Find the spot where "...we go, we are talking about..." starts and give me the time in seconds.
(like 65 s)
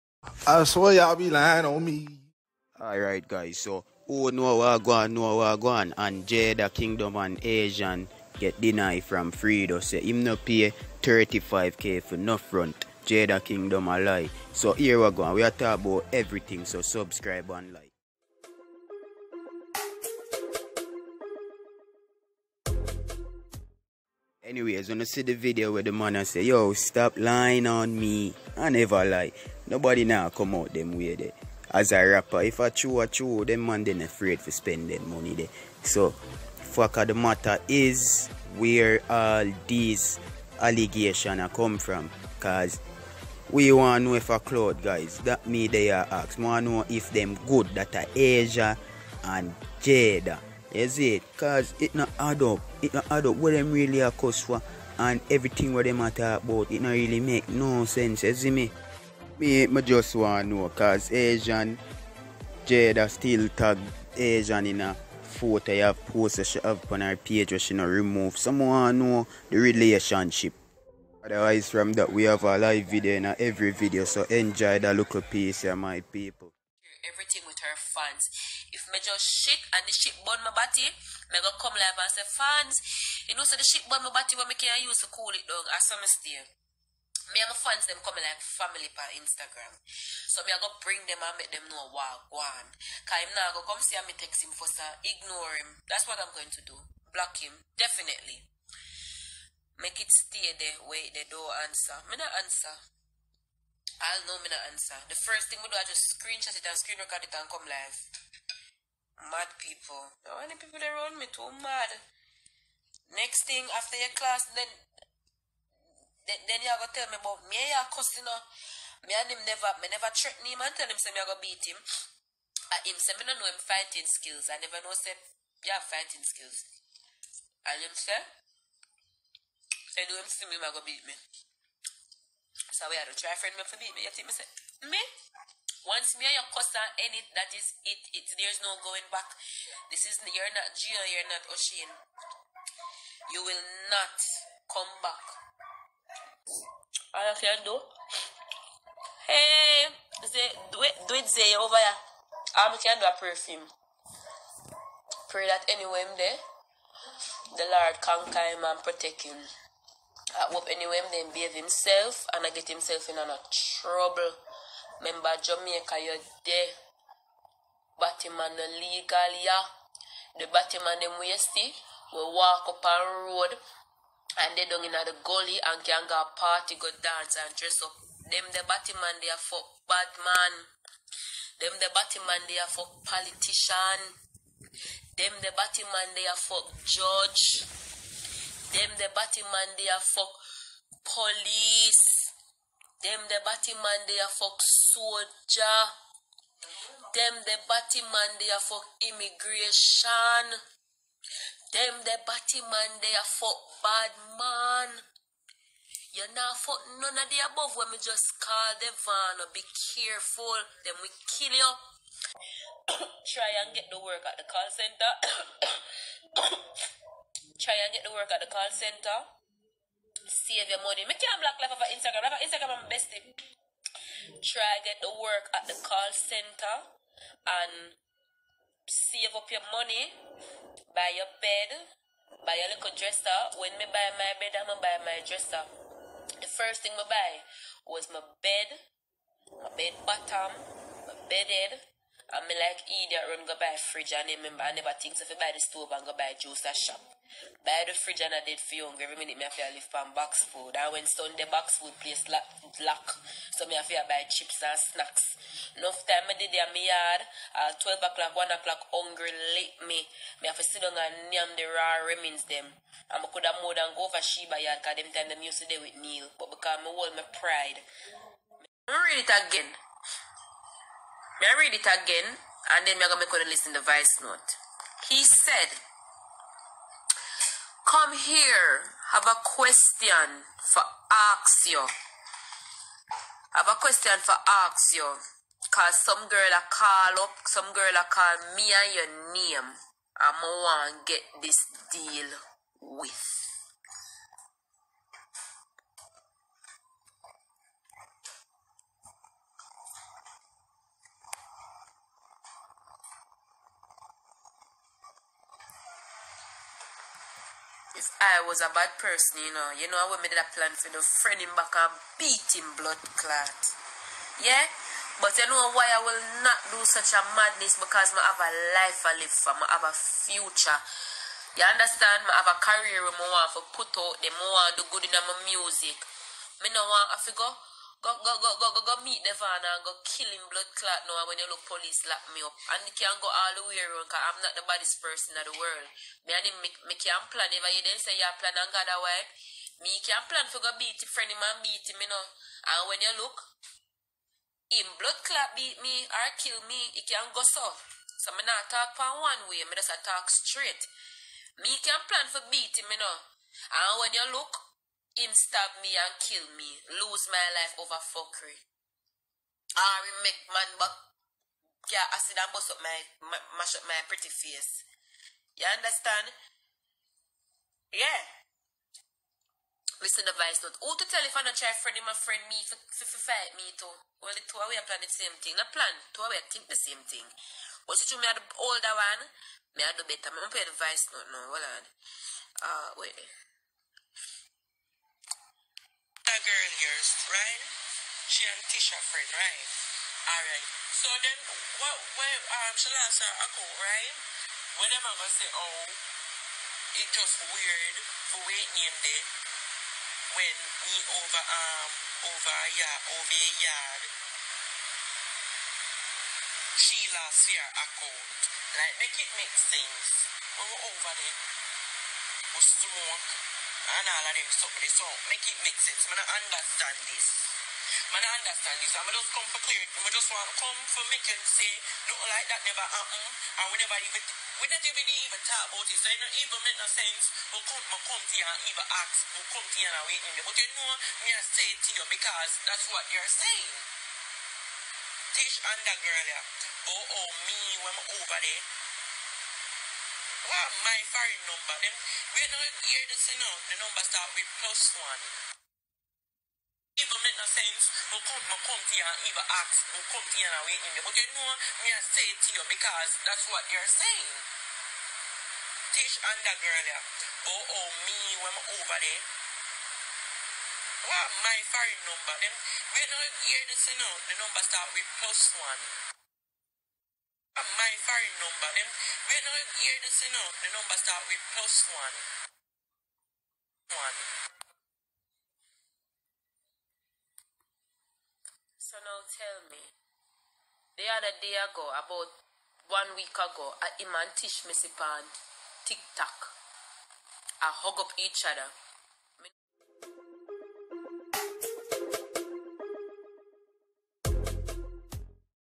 15 s.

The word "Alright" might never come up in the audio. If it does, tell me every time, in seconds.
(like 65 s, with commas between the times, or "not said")
2 s, 390 s.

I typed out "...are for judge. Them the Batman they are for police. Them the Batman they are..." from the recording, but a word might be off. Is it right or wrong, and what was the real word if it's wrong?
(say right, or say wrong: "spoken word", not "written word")
right.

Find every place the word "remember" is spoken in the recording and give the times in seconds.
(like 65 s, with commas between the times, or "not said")
164 s, 244 s.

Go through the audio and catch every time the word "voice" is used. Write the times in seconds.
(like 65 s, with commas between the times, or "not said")
273 s, 380 s.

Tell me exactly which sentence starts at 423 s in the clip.
And we never even we don't even even talk about it.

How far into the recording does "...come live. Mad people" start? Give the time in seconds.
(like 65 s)
107 s.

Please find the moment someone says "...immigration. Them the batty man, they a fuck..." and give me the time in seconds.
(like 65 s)
199 s.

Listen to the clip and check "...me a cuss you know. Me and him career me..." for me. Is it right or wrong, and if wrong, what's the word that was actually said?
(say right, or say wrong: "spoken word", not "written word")
wrong: "never", not "career".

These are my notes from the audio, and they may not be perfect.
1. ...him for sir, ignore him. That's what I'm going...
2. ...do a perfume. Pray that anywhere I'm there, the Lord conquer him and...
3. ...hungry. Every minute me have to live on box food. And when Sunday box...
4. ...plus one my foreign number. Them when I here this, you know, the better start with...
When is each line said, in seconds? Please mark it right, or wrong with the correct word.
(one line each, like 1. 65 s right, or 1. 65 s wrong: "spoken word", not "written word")
1. 94 s right
2. 152 s right
3. 248 s right
4. 465 s wrong: "number", not "better".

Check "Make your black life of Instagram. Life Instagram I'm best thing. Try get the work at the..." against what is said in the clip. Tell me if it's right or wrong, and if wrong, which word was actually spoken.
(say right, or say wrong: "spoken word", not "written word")
right.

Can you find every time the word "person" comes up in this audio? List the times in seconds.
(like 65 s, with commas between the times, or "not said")
308 s, 335 s.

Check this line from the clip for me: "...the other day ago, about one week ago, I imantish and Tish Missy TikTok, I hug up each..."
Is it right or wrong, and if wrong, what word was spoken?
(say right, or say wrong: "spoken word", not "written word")
right.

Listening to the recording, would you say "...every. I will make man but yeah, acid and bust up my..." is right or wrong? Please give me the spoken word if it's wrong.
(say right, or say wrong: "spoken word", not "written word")
wrong: "fuckery", not "every".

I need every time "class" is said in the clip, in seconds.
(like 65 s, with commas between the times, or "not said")
114 s.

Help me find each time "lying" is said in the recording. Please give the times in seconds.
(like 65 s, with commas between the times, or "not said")
1 s, 27 s.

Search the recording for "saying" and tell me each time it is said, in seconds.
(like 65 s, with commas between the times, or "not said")
433 s, 453 s.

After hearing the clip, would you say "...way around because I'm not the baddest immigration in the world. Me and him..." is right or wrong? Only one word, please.
wrong.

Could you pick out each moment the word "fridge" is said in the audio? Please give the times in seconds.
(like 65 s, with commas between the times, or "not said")
243 s, 247 s.